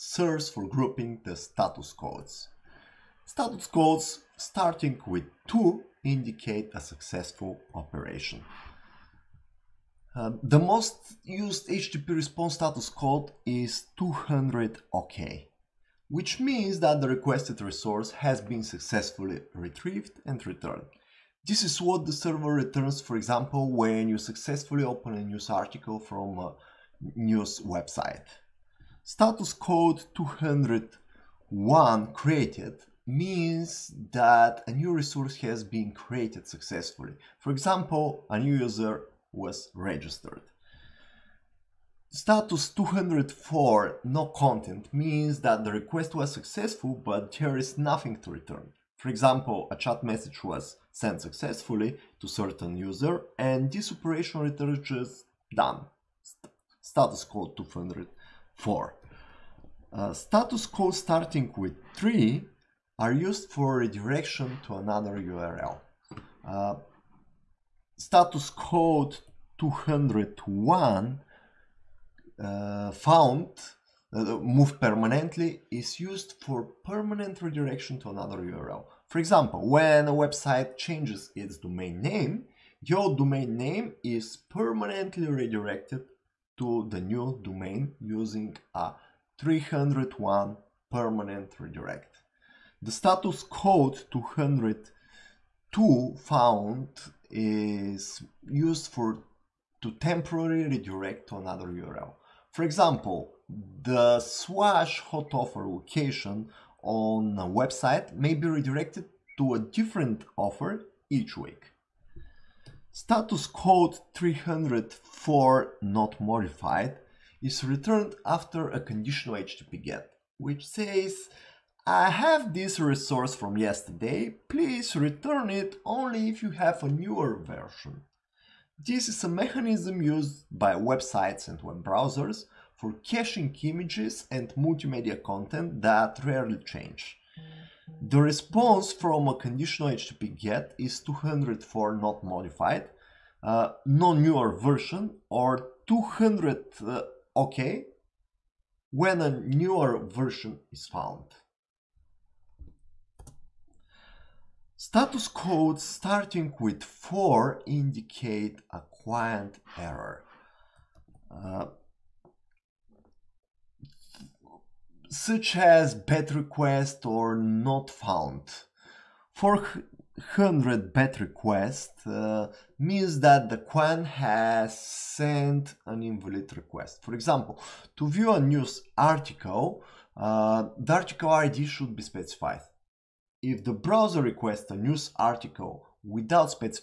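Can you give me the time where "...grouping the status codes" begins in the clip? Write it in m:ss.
0:00.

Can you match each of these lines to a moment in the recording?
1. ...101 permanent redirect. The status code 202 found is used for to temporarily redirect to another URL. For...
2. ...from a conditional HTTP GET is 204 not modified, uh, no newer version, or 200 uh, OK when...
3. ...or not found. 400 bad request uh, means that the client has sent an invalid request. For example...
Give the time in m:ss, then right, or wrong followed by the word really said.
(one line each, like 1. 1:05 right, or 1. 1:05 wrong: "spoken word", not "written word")
1. 1:29 wrong: "301", not "101"
2. 2:18 right
3. 2:47 right.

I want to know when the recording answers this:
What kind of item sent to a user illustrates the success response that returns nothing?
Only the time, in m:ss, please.
0:49.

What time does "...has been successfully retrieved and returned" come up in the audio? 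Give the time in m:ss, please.
0:18.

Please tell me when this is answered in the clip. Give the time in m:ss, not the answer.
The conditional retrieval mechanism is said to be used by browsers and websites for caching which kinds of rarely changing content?
2:13.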